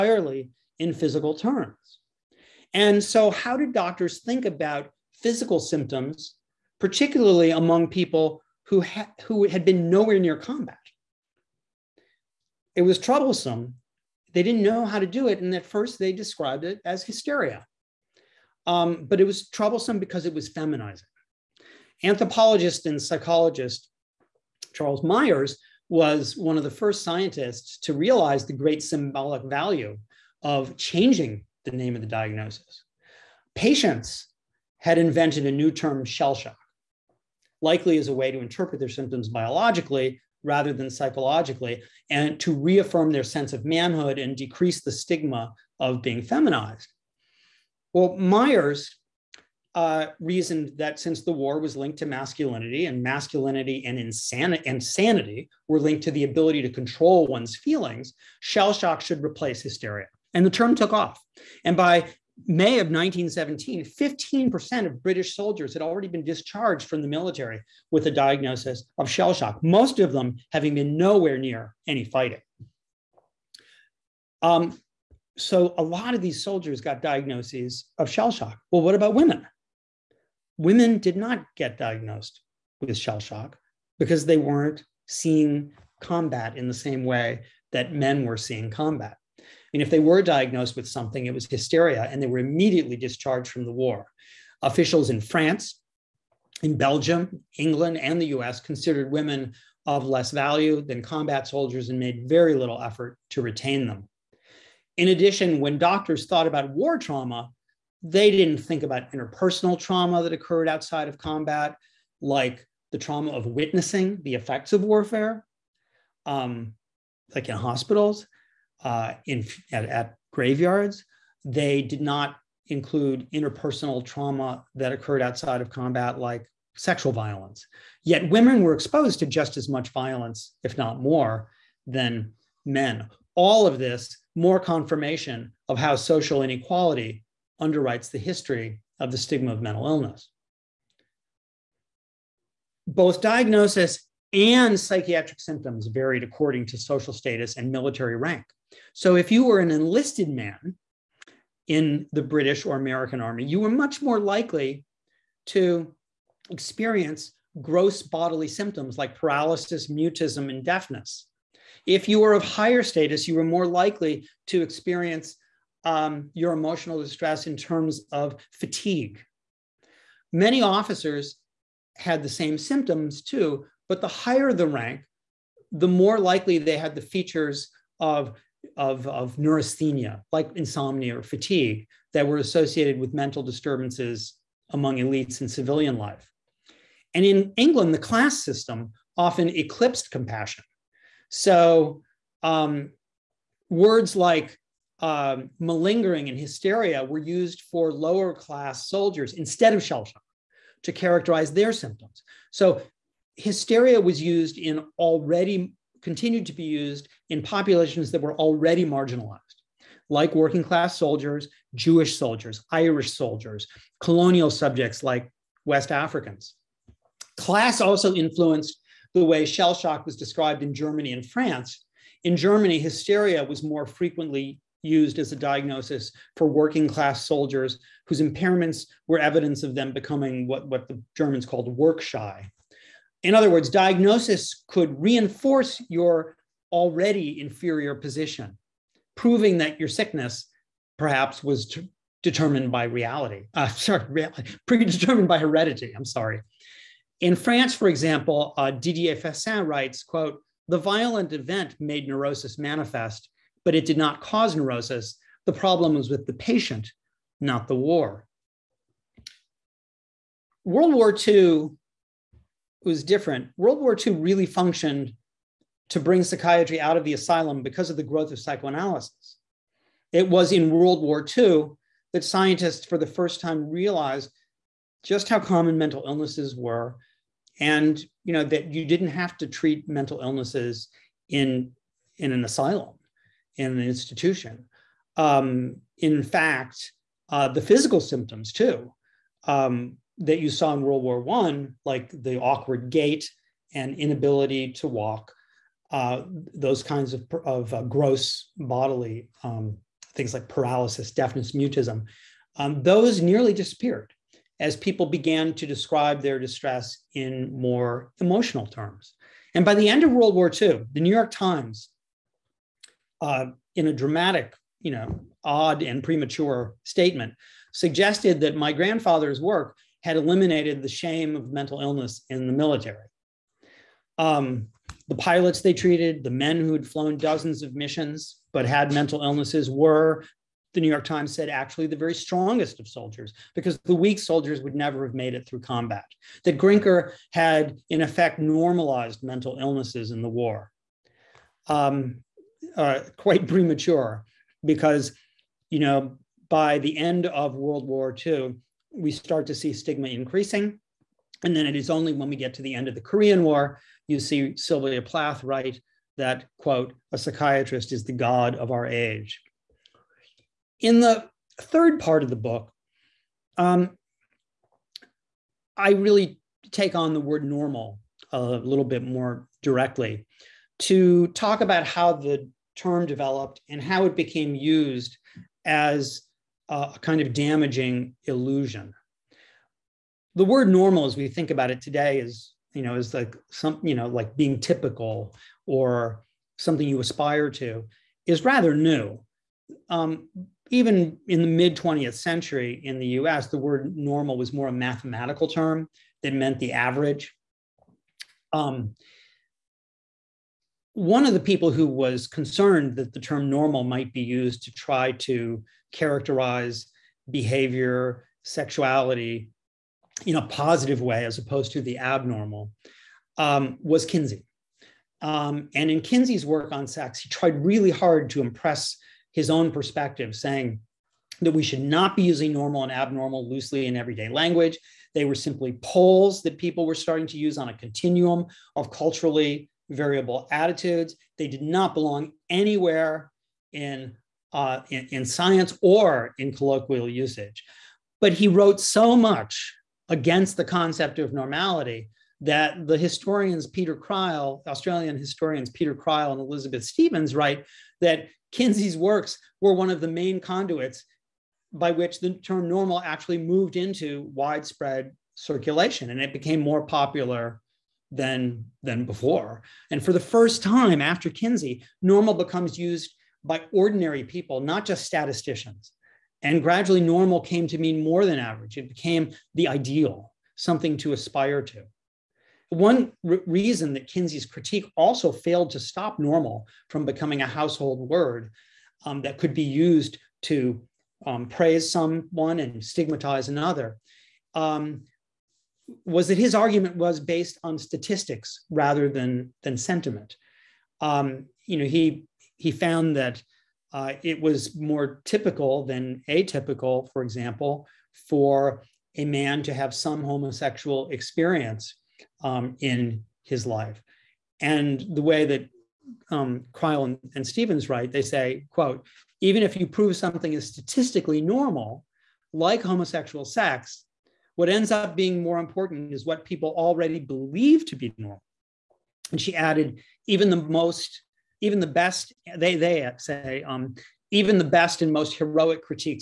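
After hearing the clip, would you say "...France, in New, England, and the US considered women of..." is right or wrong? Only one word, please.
wrong.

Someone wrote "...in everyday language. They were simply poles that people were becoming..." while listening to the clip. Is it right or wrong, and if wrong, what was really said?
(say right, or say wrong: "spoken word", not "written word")
wrong: "starting", not "becoming".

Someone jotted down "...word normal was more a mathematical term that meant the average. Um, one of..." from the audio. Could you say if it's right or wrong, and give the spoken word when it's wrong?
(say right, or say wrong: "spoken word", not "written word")
right.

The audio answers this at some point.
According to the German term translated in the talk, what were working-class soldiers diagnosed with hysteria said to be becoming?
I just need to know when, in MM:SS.
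03:51.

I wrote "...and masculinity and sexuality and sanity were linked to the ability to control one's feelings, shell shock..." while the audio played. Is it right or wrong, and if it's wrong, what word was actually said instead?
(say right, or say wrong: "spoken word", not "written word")
wrong: "insanity", not "sexuality".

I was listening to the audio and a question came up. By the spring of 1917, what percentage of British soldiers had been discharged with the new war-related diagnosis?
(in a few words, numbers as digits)
15%.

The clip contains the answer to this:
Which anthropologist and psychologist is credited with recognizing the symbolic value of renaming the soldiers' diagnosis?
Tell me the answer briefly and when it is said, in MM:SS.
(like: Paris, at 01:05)
Charles Myers, at 00:24.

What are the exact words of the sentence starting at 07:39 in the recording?
And for the first time after Kinsey, normal becomes used by ordinary people, not just statisticians.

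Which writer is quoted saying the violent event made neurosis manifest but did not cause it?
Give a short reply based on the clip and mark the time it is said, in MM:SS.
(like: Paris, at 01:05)
Didier Fassin, at 04:08.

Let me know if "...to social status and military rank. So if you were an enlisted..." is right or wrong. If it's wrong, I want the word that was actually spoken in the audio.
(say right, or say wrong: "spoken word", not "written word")
right.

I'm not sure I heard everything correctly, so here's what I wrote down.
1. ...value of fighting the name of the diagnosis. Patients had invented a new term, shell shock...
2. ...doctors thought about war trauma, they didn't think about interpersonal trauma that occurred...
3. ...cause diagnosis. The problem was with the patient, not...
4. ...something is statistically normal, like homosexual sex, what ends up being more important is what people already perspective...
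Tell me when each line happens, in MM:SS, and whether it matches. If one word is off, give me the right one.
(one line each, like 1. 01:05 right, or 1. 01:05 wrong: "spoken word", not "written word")
1. 00:29 wrong: "changing", not "fighting"
2. 01:45 right
3. 04:14 wrong: "neurosis", not "diagnosis"
4. 08:30 wrong: "believe", not "perspective".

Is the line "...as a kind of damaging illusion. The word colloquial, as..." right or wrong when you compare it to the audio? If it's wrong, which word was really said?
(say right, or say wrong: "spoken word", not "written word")
wrong: "normal", not "colloquial".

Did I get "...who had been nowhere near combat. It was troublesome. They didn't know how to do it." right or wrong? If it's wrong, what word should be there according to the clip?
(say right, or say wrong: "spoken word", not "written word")
right.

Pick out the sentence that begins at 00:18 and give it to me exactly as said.
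Um, but it was troublesome because it was feminizing.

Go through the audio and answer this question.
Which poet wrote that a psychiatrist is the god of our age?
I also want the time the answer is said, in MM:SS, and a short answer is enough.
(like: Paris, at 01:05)
Sylvia Plath, at 05:54.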